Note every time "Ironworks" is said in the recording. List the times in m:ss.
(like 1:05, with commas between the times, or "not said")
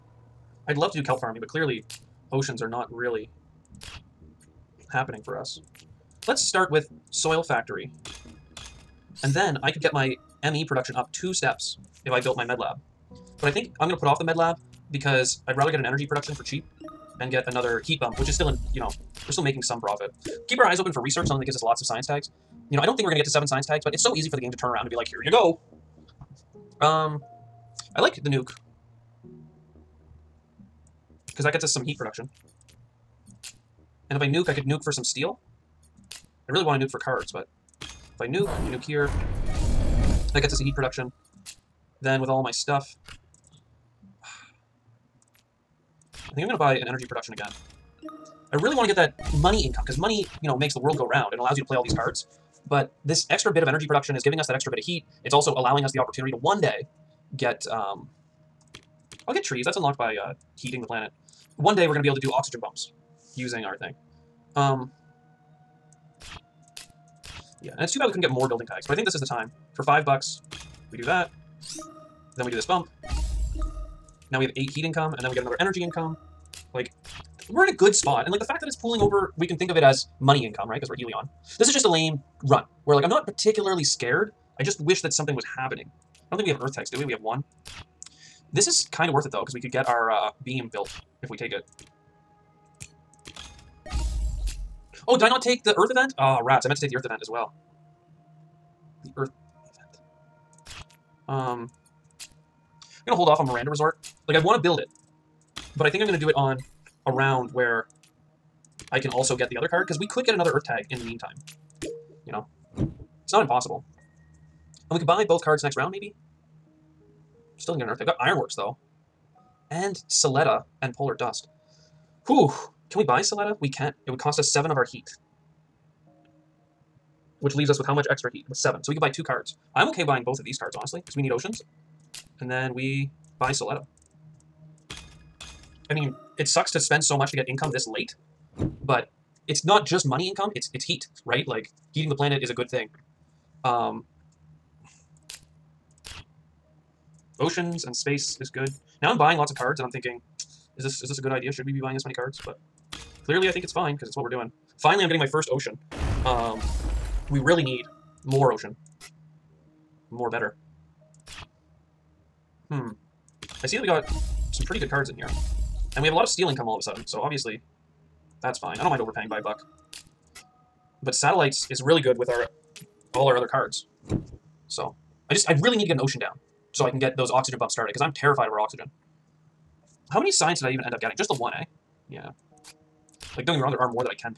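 1:58.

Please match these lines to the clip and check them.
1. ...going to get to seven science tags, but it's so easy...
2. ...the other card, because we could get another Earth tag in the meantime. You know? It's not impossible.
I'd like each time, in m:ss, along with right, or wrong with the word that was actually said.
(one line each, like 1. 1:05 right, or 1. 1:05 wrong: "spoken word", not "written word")
1. 0:23 right
2. 1:49 right.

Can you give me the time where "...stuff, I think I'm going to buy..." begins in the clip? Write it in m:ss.
0:42.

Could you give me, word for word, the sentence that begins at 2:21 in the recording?
Like heating the planet is a good thing.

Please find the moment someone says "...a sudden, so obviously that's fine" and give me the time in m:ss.
2:46.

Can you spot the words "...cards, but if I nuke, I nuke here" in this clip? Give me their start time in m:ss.
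0:36.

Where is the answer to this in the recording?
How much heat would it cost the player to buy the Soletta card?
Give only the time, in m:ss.
2:04.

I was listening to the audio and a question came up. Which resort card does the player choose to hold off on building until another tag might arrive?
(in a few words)
Miranda Resort.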